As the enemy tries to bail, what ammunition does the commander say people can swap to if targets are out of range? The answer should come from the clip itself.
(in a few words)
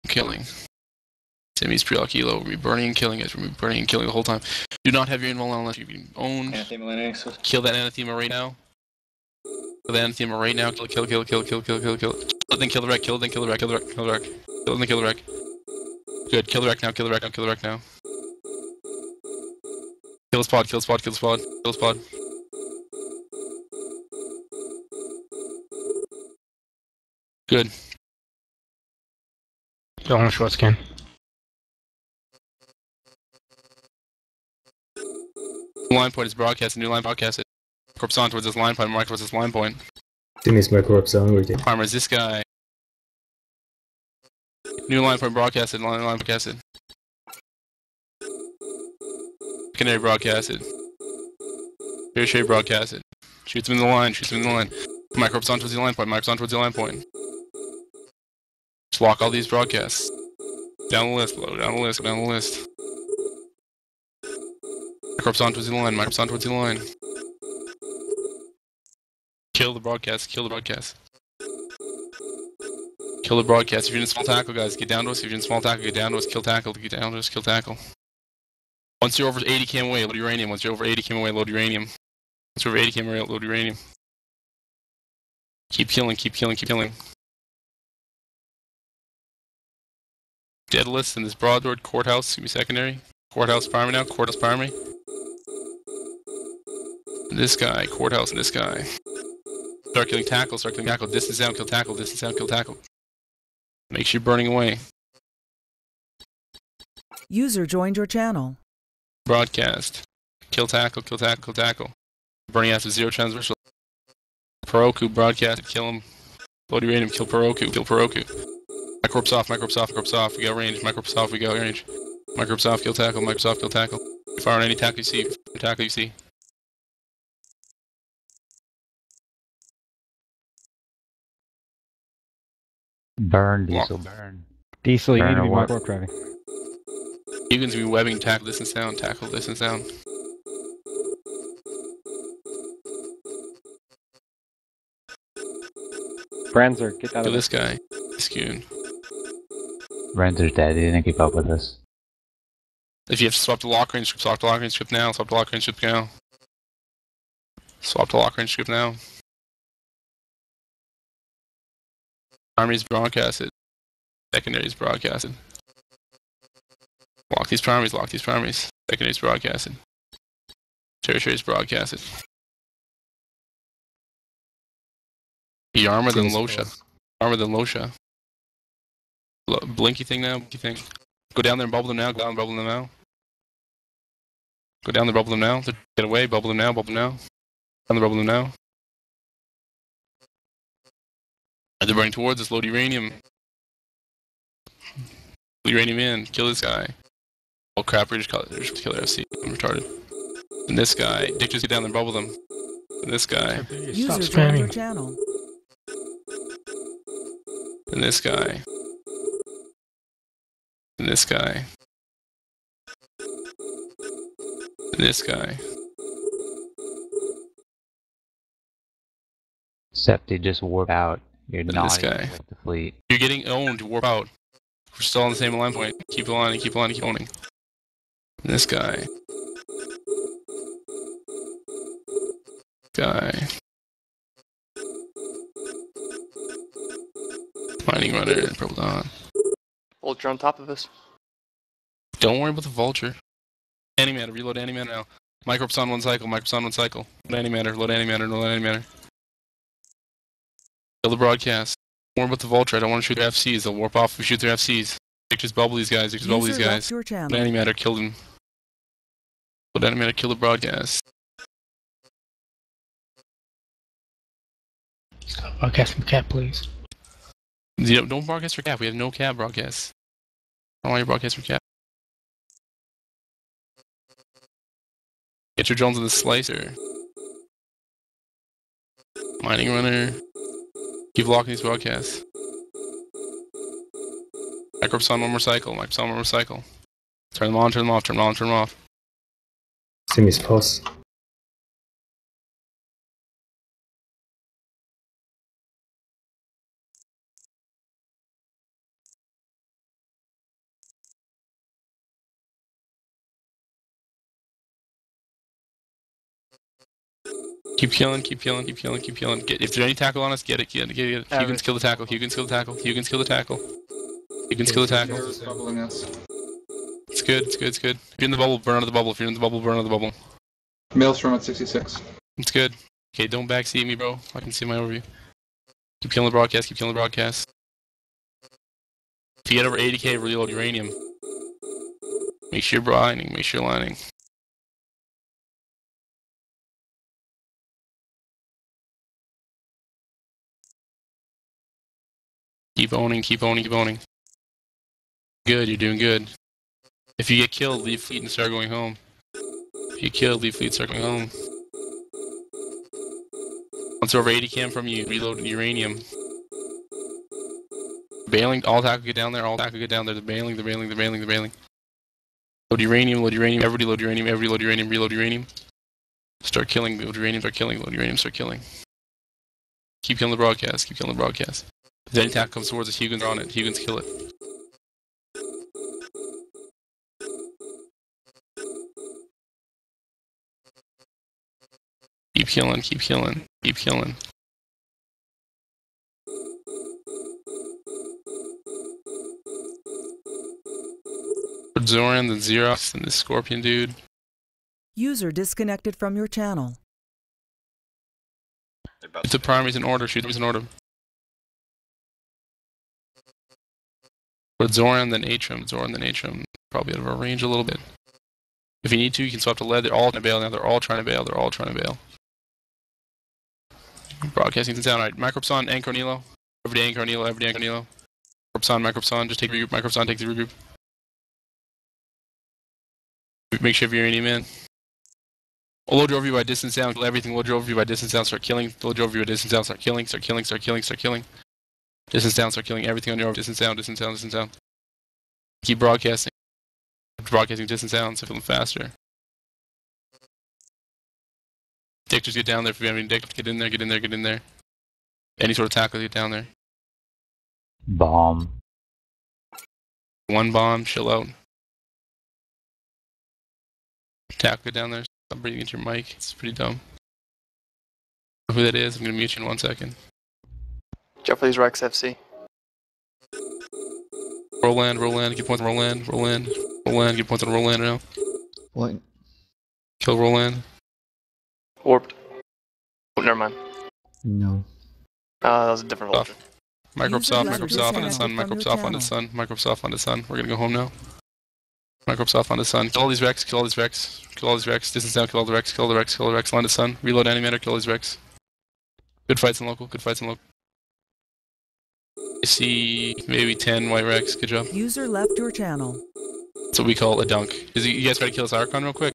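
lead.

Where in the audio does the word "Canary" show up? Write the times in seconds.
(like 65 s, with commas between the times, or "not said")
49 s.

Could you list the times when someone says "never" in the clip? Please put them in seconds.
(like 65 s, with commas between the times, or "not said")
473 s.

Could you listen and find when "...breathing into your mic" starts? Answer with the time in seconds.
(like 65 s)
455 s.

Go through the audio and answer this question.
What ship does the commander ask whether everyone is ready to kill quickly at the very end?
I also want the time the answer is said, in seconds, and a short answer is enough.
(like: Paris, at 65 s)
Archon, at 498 s.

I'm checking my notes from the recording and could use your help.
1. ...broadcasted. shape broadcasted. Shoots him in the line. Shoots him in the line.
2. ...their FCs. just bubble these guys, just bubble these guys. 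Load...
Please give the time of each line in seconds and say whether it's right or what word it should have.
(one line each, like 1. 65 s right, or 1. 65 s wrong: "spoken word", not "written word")
1. 49 s right
2. 254 s right.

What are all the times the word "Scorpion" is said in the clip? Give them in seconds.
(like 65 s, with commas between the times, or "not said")
393 s.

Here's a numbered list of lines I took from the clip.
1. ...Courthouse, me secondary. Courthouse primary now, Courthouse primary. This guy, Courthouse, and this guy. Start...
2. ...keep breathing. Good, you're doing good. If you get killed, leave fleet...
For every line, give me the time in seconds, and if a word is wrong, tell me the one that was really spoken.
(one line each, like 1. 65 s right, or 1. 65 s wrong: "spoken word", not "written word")
1. 91 s right
2. 343 s wrong: "owning", not "breathing".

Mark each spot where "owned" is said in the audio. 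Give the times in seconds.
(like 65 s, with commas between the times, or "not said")
6 s, 223 s.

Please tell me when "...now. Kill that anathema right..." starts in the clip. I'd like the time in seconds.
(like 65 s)
8 s.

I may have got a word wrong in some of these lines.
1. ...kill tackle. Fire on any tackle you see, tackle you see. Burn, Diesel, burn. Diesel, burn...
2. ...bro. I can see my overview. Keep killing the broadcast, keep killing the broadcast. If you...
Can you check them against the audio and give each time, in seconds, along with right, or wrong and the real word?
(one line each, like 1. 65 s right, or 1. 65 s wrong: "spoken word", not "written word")
1. 123 s right
2. 323 s right.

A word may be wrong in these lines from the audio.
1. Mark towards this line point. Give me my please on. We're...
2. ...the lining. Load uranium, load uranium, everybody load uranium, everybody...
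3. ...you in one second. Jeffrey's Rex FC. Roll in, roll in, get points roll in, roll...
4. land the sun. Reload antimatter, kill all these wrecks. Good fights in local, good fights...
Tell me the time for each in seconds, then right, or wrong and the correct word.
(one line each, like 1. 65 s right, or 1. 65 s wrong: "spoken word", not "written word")
1. 38 s wrong: "corpse", not "please"
2. 361 s wrong: "bailing", not "lining"
3. 459 s right
4. 486 s right.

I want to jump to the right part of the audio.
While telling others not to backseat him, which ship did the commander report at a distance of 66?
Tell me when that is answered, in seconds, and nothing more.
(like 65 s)
320 s.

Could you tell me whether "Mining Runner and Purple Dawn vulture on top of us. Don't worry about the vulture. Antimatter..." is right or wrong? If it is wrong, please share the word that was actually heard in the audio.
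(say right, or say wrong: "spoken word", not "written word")
right.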